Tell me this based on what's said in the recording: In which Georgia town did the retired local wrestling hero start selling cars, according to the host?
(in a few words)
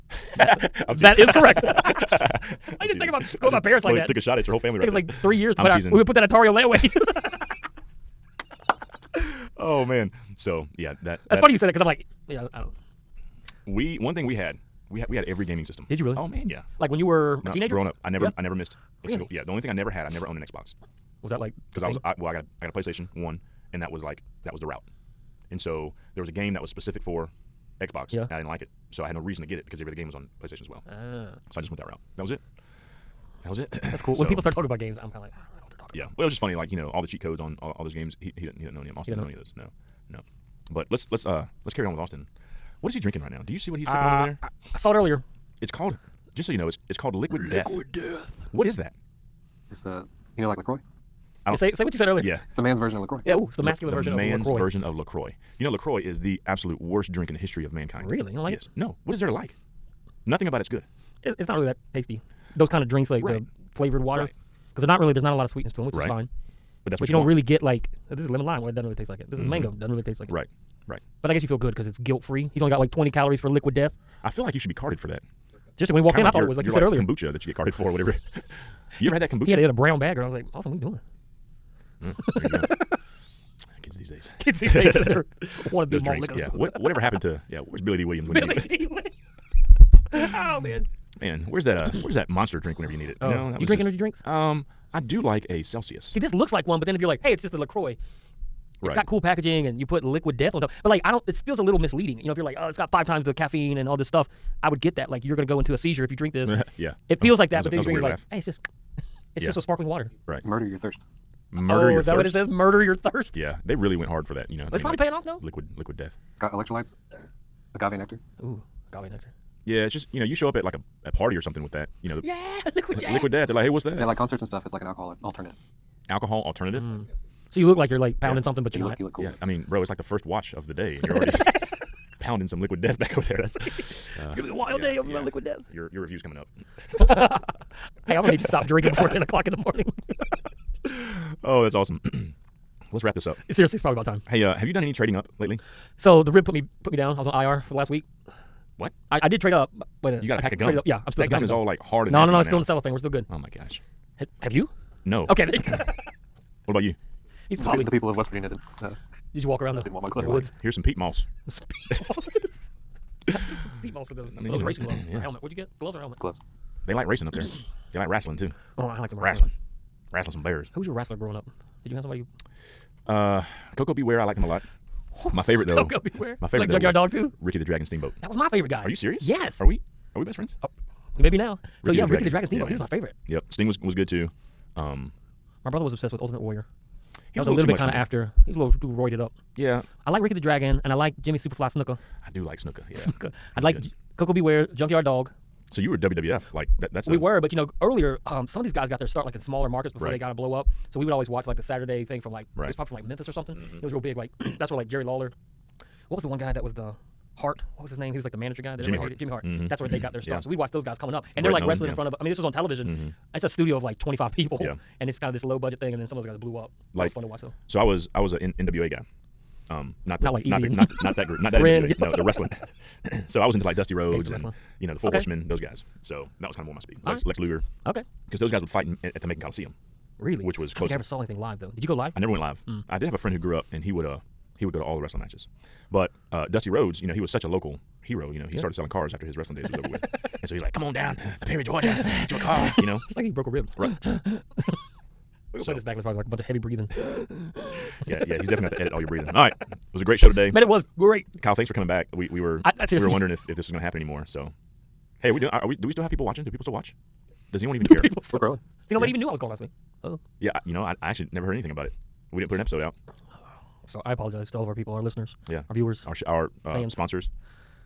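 Perry, Georgia.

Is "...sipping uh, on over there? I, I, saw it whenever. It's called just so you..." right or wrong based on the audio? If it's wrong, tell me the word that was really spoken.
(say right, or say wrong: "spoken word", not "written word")
wrong: "earlier", not "whenever".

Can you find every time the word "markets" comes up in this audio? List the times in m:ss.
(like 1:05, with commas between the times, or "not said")
3:19.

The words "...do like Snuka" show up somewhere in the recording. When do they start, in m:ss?
3:12.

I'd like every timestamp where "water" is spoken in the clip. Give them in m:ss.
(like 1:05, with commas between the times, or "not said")
1:03, 1:49.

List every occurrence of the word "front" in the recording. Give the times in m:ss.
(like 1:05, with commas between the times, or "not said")
3:31.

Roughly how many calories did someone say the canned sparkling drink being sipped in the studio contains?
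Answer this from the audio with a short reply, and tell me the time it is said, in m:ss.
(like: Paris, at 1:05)
20, at 1:12.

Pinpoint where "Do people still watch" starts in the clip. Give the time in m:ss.
4:16.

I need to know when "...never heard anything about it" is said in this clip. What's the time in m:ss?
4:21.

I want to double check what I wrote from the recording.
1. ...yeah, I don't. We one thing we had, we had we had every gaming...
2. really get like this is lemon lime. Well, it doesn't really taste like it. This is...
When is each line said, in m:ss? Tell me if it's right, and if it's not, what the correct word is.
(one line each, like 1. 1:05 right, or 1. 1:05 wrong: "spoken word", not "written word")
1. 0:12 right
2. 1:07 right.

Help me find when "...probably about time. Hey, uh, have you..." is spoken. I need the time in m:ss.
2:23.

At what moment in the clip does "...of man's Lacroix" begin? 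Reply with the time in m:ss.
0:54.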